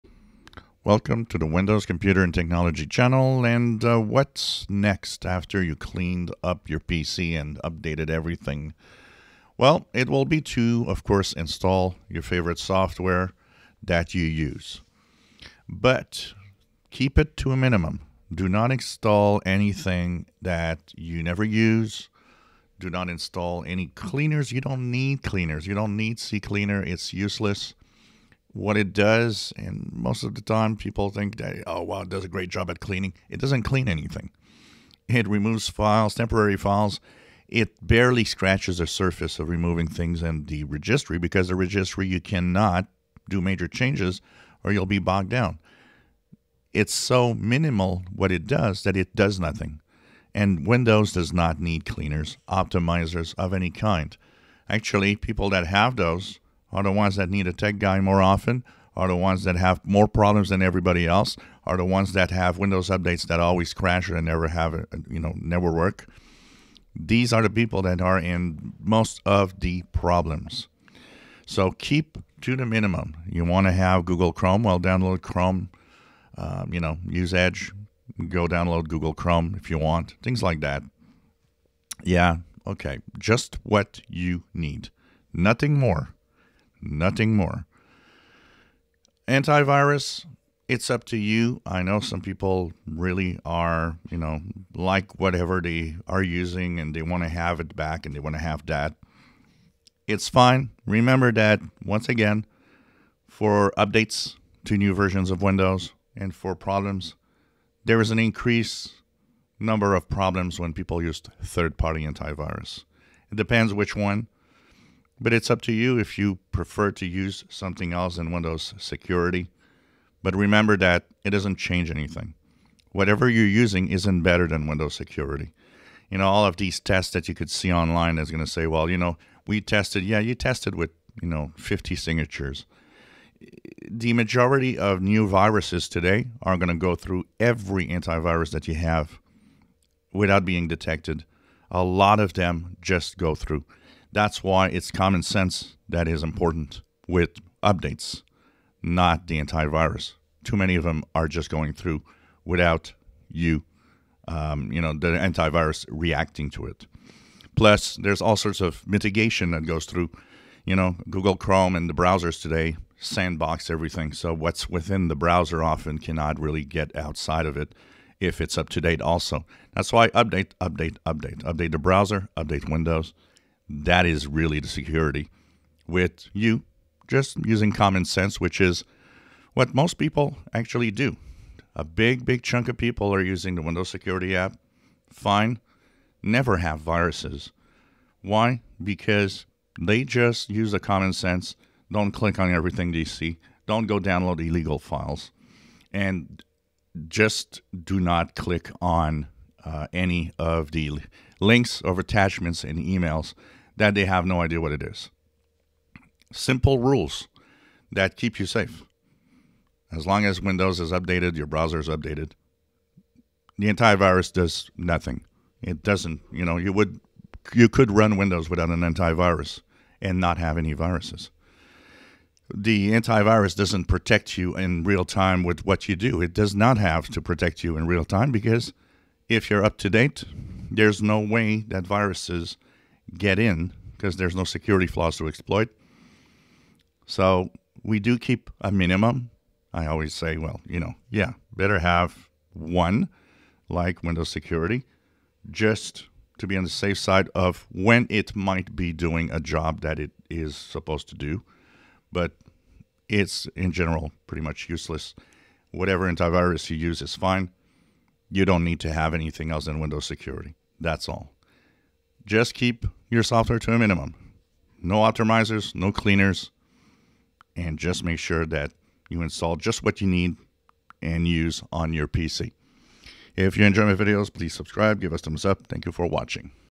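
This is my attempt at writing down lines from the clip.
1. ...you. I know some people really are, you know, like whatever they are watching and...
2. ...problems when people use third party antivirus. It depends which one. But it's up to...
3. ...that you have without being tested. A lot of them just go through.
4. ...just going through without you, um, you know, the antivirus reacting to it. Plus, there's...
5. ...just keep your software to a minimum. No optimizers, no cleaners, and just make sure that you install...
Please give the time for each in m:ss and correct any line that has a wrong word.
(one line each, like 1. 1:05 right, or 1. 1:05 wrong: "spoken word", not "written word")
1. 1:31 wrong: "using", not "watching"
2. 1:50 right
3. 2:18 wrong: "detected", not "tested"
4. 2:31 right
5. 4:22 right.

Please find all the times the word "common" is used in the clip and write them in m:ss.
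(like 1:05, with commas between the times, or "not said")
2:24, 2:57, 3:10.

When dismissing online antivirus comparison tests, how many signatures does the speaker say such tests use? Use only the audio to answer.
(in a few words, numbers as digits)
50.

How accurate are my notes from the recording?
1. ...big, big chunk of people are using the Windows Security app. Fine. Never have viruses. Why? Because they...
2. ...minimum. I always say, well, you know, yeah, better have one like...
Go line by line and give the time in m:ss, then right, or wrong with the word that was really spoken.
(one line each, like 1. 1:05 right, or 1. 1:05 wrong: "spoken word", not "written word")
1. 3:01 right
2. 3:58 right.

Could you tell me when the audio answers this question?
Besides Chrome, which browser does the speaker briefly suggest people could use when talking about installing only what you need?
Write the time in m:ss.
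1:17.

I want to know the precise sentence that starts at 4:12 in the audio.
But it's in general pretty much useless.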